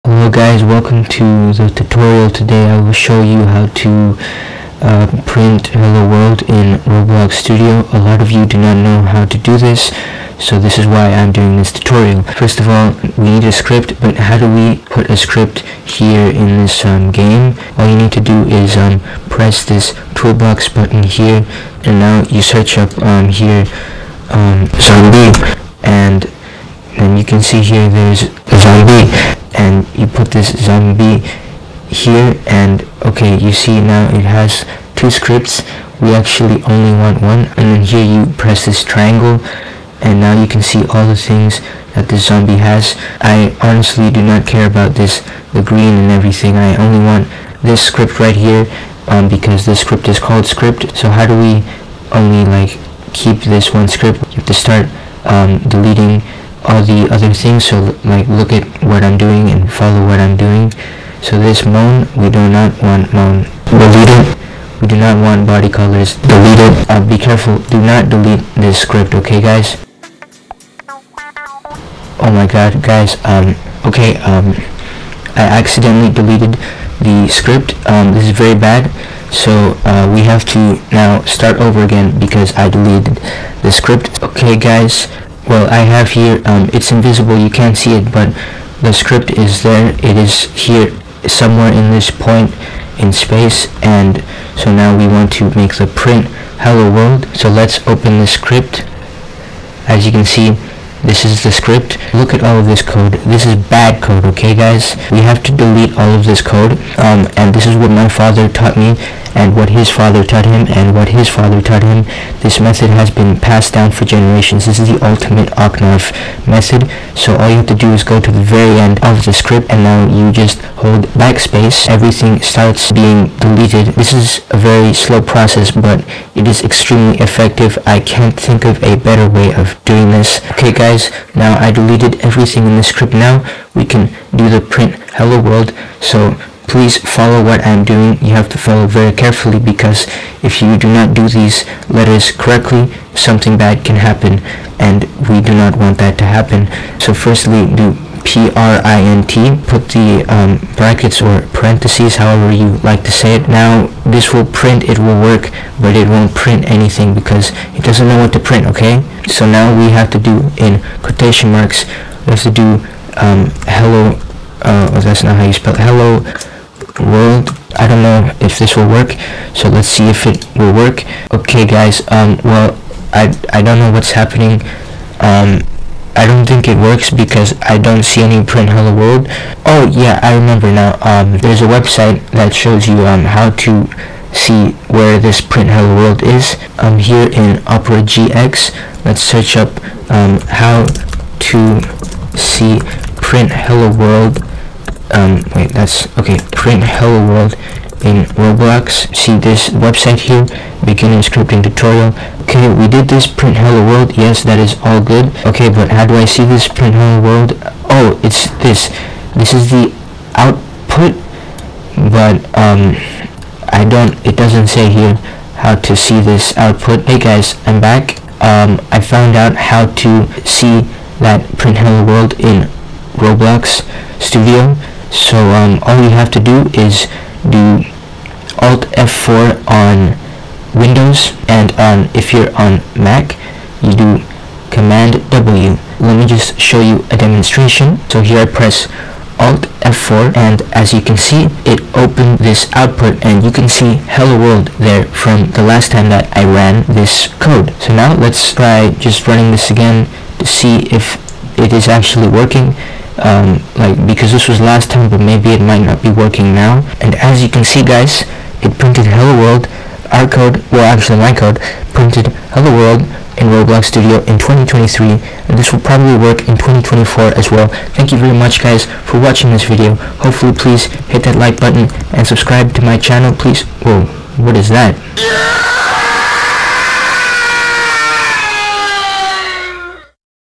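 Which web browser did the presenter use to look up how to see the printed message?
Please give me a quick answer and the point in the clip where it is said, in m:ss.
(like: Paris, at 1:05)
Opera GX, at 3:07.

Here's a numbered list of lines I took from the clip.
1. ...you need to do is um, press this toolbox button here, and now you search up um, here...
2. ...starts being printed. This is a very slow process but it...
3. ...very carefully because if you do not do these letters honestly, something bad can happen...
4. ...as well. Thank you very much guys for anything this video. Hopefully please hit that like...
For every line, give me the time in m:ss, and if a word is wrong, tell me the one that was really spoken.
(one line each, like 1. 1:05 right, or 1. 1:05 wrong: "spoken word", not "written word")
1. 0:17 right
2. 2:02 wrong: "deleted", not "printed"
3. 2:18 wrong: "correctly", not "honestly"
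4. 4:27 wrong: "watching", not "anything".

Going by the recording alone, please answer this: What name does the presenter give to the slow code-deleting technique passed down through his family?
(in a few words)
Ocnarf method.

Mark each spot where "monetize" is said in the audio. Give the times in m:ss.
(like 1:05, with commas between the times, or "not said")
not said.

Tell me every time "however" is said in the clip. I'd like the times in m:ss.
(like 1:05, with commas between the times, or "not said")
2:32.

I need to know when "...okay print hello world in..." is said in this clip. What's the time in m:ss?
3:16.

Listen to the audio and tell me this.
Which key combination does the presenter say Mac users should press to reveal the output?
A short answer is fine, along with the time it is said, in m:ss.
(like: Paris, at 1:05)
Command W, at 3:54.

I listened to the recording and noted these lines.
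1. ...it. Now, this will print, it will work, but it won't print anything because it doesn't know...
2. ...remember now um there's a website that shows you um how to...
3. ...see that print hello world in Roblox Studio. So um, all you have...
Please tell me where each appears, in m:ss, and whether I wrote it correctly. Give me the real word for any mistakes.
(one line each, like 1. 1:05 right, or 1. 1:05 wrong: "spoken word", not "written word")
1. 2:33 right
2. 3:00 right
3. 3:40 right.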